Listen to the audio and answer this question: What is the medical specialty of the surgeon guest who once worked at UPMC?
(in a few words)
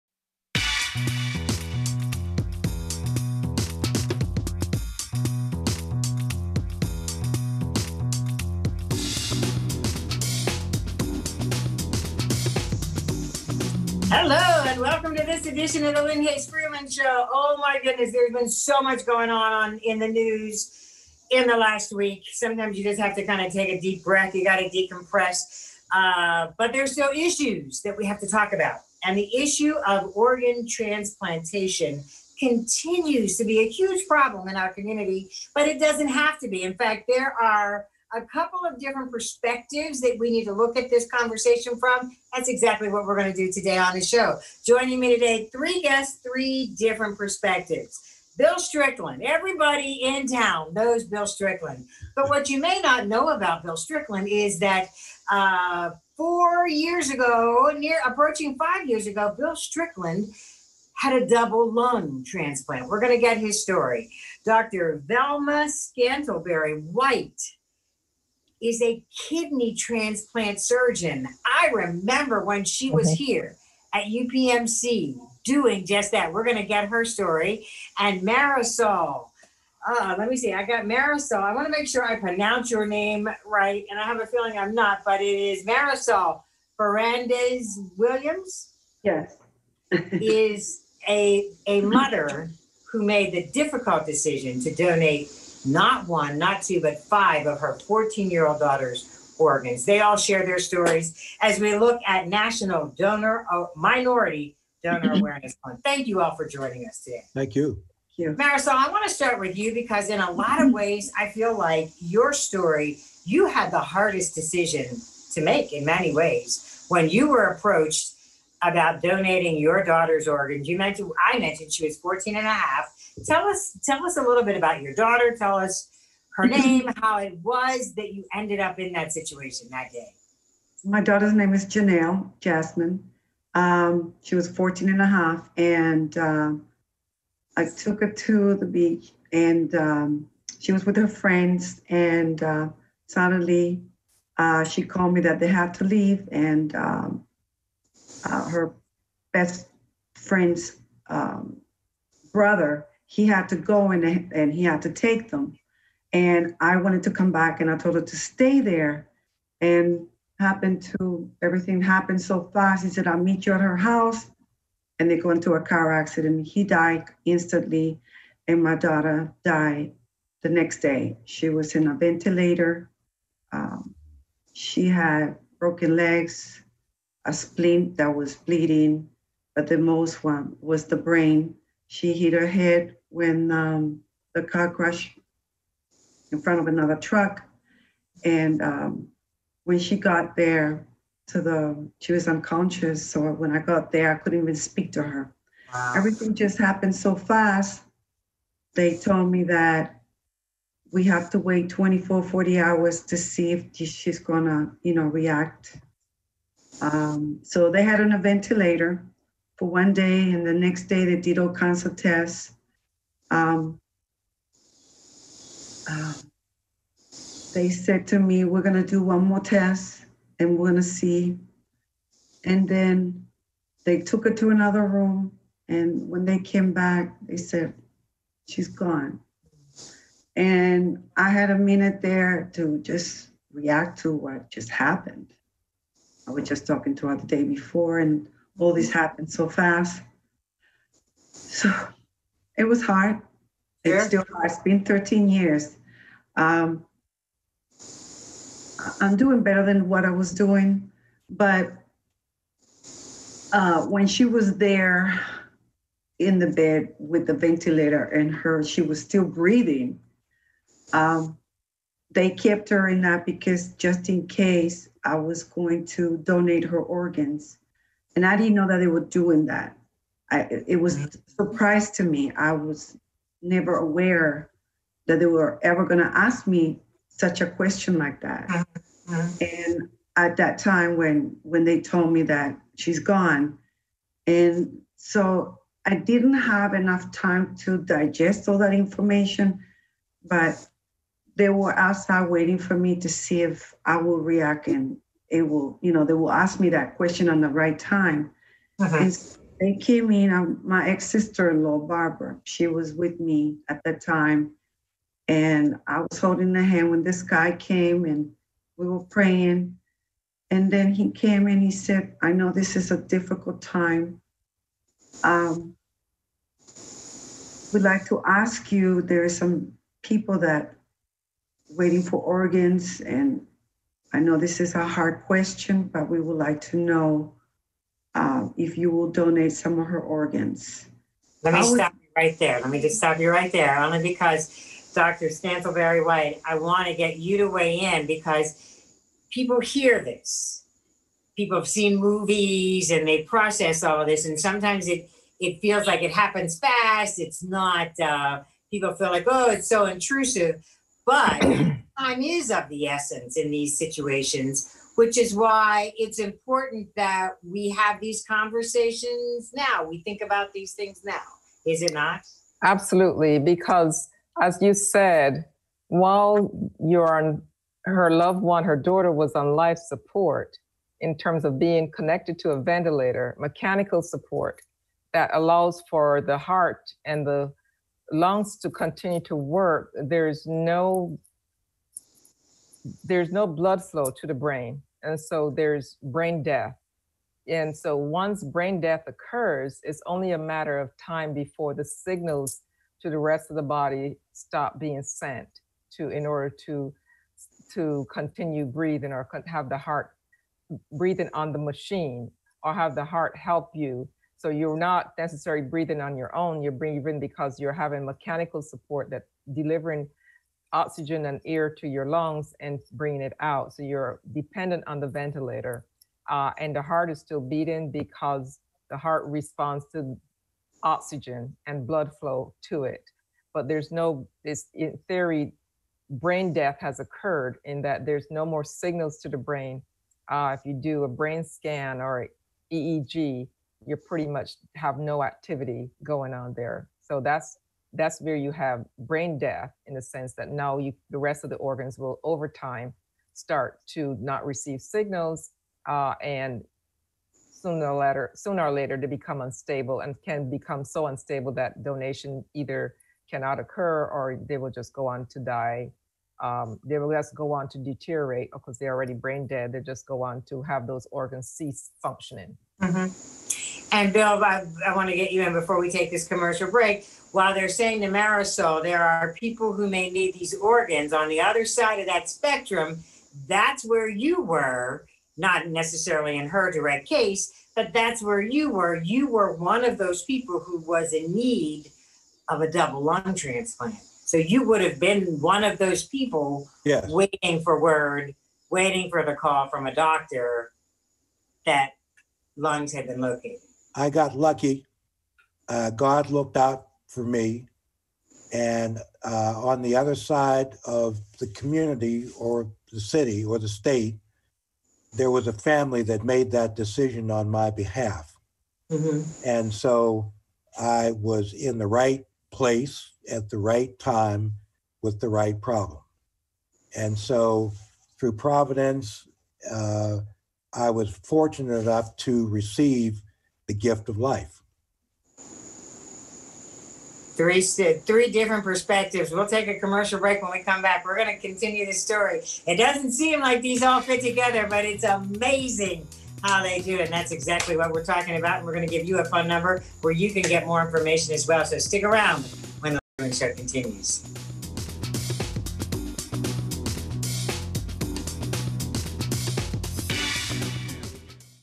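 kidney transplant surgeon.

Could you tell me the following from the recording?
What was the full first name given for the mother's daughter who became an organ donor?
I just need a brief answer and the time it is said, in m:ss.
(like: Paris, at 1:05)
Janelle Jasmine, at 2:11.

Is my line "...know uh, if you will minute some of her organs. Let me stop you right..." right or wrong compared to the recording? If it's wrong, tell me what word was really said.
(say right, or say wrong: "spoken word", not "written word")
wrong: "donate", not "minute".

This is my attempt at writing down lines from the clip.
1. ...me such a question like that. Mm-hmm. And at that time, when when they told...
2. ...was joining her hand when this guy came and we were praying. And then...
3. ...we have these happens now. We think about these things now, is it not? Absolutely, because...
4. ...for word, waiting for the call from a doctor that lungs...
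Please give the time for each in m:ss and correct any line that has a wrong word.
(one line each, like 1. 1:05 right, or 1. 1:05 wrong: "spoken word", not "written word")
1. 4:36 right
2. 5:06 wrong: "holding", not "joining"
3. 5:57 wrong: "conversations", not "happens"
4. 8:07 right.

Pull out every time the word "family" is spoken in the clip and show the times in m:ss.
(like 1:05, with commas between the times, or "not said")
8:25.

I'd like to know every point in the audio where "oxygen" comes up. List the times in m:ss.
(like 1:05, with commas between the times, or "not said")
6:50, 7:00.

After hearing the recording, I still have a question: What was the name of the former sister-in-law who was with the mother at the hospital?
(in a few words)
Barbara.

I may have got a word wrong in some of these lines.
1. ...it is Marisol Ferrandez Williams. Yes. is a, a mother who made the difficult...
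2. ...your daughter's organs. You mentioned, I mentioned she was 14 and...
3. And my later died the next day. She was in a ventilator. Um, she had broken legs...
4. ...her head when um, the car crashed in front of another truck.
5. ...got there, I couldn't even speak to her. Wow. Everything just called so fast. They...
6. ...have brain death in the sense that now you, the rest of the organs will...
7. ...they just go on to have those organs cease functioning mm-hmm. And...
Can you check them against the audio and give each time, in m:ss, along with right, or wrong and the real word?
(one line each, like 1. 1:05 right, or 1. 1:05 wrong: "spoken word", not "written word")
1. 1:25 right
2. 1:59 right
3. 2:48 wrong: "daughter", not "later"
4. 3:02 right
5. 3:13 wrong: "happened", not "called"
6. 7:18 right
7. 7:39 right.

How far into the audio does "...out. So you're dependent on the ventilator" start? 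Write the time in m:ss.
6:53.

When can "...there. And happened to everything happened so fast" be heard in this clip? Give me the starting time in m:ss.
2:38.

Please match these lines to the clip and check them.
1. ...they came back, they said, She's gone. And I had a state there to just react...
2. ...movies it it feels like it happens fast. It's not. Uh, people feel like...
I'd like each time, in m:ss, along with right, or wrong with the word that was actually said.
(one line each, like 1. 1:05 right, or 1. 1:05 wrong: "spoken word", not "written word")
1. 3:46 wrong: "minute", not "state"
2. 5:44 wrong: "sometimes", not "movies".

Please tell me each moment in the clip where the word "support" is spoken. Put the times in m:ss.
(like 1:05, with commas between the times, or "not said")
6:09, 6:14, 6:48.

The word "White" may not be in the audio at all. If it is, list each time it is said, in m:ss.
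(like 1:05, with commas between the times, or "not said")
1:06, 5:36.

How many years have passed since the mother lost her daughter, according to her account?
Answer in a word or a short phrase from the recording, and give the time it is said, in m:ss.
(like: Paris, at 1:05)
13, at 4:04.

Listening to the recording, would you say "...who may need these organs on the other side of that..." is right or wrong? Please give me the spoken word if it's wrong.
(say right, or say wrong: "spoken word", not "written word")
right.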